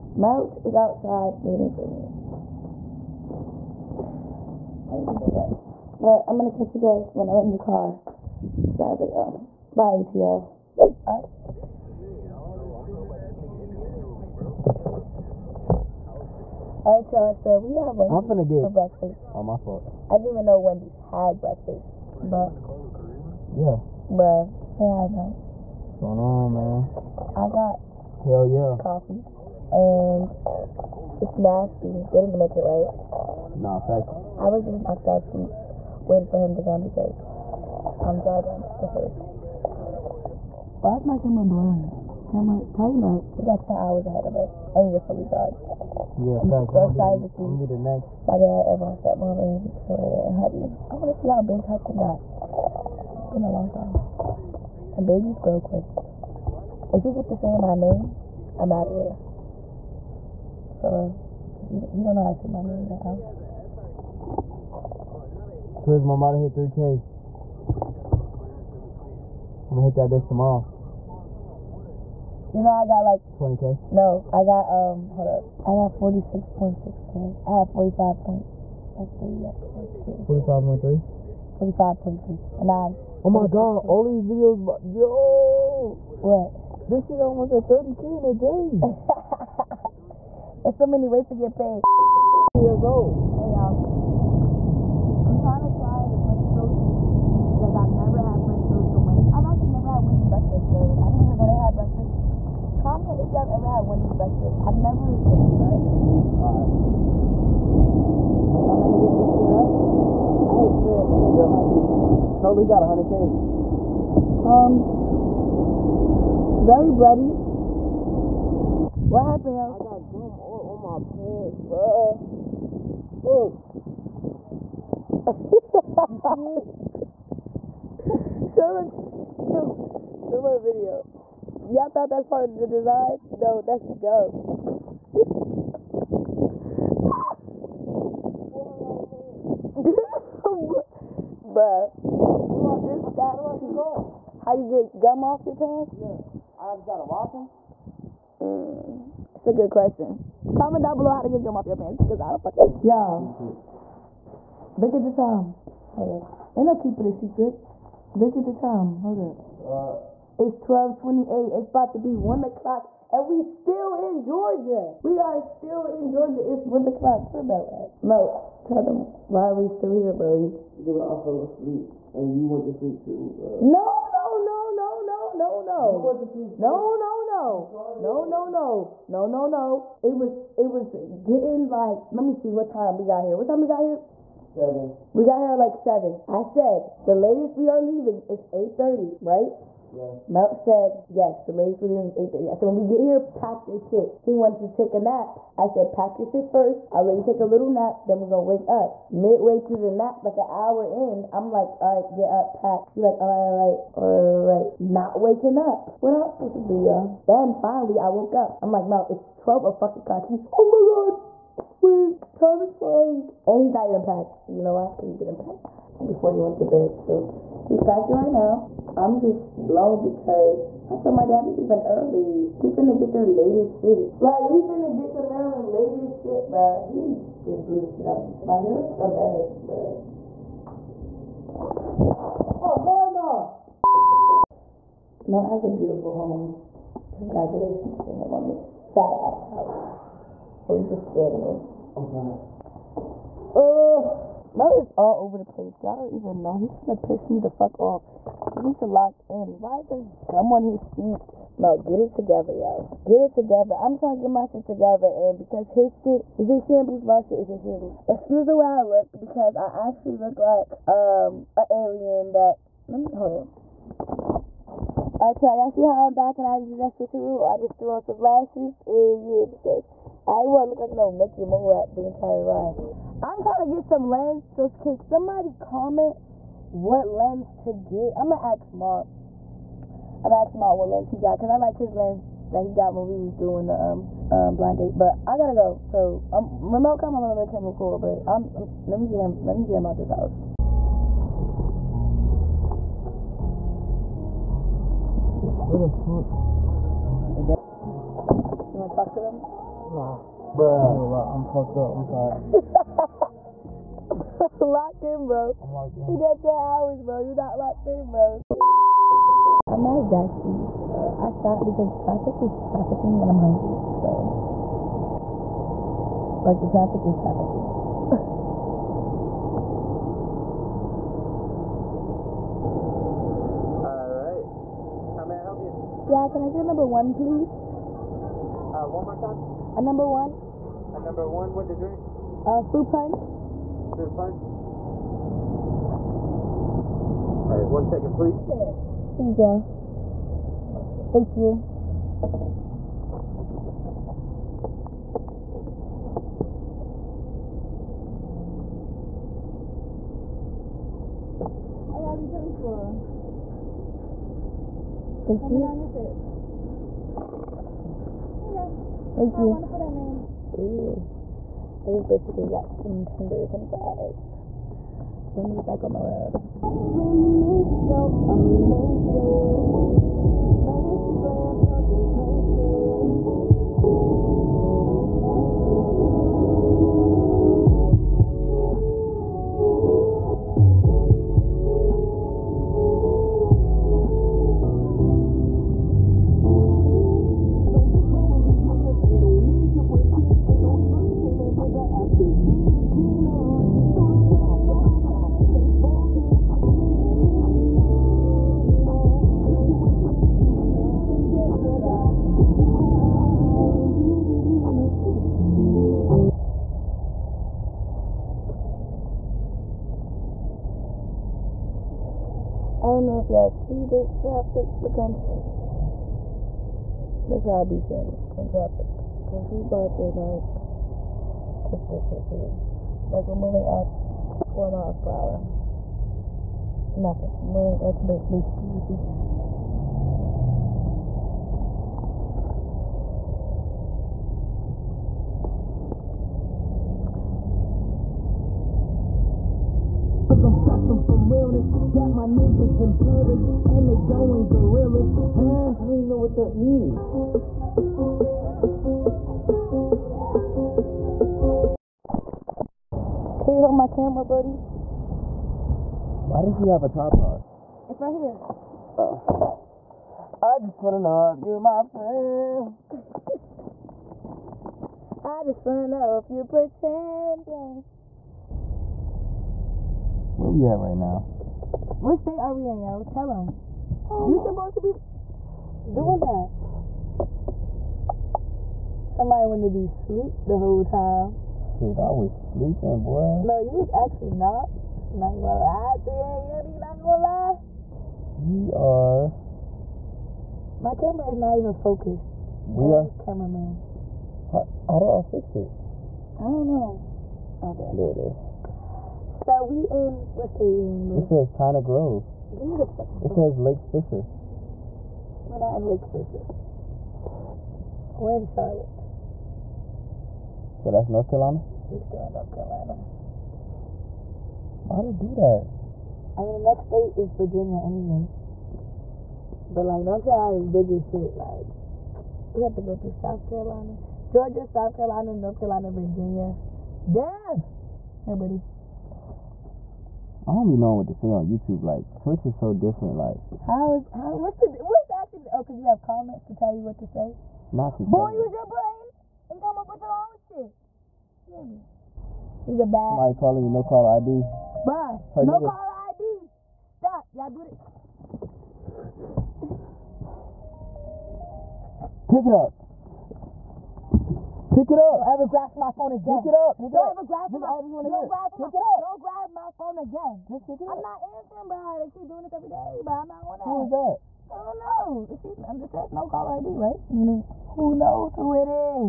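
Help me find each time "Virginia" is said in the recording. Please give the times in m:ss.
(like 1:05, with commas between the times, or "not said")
8:37, 8:45.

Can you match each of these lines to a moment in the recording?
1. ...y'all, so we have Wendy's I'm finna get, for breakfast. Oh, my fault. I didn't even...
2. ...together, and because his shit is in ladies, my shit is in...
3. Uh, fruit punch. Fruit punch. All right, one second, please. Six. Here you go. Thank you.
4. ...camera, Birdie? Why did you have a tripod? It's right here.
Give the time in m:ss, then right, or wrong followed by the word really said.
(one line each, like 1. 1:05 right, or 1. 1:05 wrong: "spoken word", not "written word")
1. 0:17 right
2. 4:14 wrong: "shambles", not "ladies"
3. 5:32 right
4. 7:33 right.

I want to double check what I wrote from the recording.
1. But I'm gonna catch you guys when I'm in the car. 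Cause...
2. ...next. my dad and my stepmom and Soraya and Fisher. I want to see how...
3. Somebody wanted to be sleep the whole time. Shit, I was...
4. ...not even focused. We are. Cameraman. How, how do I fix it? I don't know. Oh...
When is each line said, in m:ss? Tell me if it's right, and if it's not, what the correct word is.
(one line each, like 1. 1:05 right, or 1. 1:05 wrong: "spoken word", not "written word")
1. 0:05 right
2. 0:47 wrong: "Huddy", not "Fisher"
3. 7:59 right
4. 8:11 right.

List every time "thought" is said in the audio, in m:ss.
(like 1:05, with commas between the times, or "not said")
2:11.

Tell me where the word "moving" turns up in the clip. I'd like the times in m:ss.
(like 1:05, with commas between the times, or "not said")
7:03, 7:07.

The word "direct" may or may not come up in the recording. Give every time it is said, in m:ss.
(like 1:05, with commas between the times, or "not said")
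not said.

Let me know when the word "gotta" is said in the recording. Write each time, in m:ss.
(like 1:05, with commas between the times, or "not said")
2:26.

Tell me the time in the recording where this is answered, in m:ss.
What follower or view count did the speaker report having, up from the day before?
1:15.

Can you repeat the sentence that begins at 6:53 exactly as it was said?
if y'all see this traffic, look I'm sitting.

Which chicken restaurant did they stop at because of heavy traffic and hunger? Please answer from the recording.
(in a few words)
Zaxby's.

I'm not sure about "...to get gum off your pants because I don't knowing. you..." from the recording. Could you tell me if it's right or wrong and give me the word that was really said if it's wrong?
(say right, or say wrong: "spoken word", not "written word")
wrong: "fucking", not "knowing".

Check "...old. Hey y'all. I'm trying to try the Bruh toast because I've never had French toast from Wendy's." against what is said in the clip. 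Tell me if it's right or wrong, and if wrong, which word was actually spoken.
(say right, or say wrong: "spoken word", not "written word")
wrong: "French", not "Bruh".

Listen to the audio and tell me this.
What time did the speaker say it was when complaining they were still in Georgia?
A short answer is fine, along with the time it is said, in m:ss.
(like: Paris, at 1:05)
12:28, at 2:40.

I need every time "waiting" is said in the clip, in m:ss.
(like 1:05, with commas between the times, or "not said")
0:01, 0:36.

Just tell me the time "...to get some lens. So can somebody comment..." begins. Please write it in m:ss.
4:33.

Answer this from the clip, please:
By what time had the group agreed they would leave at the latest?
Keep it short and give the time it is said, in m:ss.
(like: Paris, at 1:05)
8:30, at 3:08.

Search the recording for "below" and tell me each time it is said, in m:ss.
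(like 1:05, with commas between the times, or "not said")
2:30.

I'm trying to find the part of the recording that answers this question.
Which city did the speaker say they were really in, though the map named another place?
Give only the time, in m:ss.
8:28.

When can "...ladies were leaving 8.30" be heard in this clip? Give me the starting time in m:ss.
3:11.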